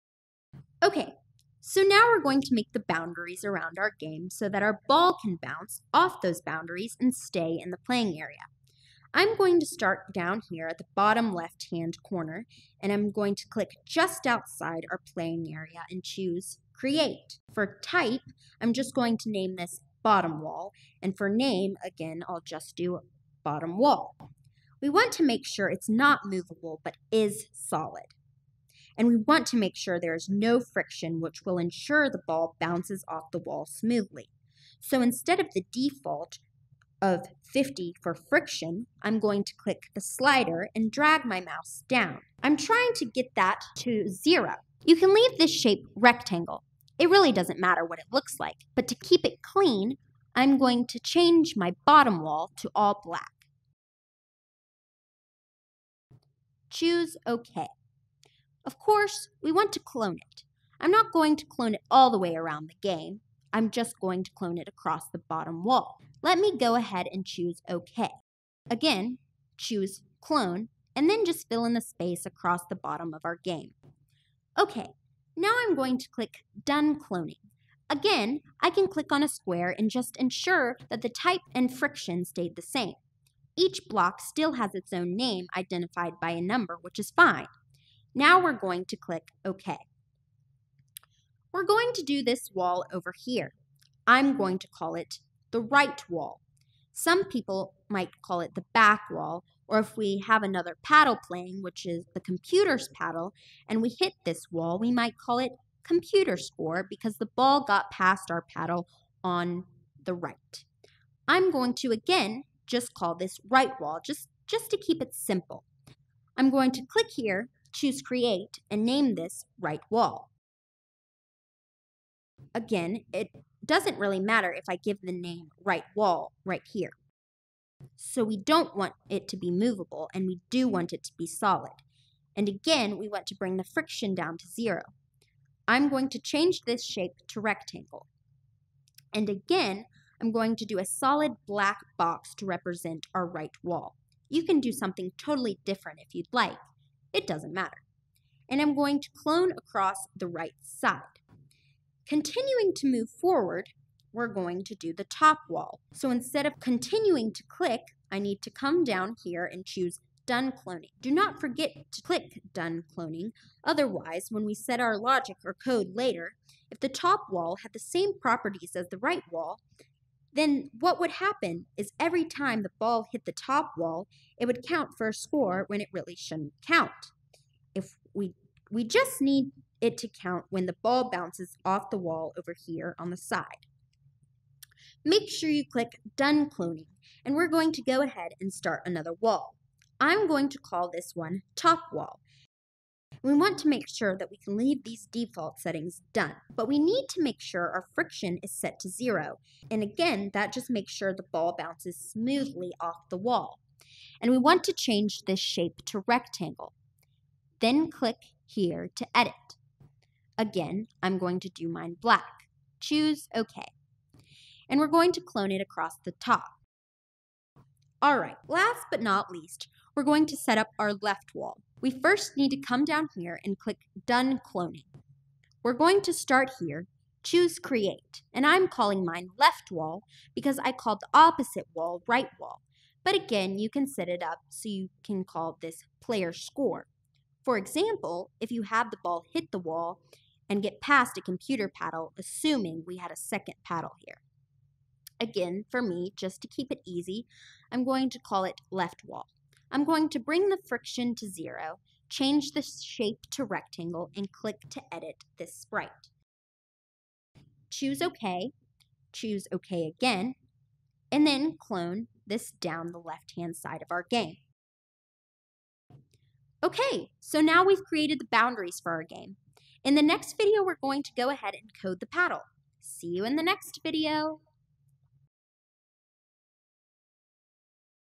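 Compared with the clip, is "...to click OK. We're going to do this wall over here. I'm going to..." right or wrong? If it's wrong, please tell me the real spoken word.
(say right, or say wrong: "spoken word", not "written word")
right.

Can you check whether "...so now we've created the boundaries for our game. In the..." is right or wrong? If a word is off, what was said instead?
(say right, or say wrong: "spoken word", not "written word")
right.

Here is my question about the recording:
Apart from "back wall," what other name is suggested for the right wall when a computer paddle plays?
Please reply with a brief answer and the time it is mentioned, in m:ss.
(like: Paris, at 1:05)
computer score, at 1:45.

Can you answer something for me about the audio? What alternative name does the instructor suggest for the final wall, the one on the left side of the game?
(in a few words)
Player Score.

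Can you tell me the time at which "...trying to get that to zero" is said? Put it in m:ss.
0:42.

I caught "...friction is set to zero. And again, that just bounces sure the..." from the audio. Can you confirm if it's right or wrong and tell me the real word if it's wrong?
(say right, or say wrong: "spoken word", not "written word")
wrong: "makes", not "bounces".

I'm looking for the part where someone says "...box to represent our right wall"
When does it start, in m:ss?
2:21.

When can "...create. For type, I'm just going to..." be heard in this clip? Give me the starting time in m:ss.
0:16.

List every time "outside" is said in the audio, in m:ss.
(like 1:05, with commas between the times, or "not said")
0:14.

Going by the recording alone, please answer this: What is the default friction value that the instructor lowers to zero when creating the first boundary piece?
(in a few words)
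50.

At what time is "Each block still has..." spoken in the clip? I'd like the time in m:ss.
1:23.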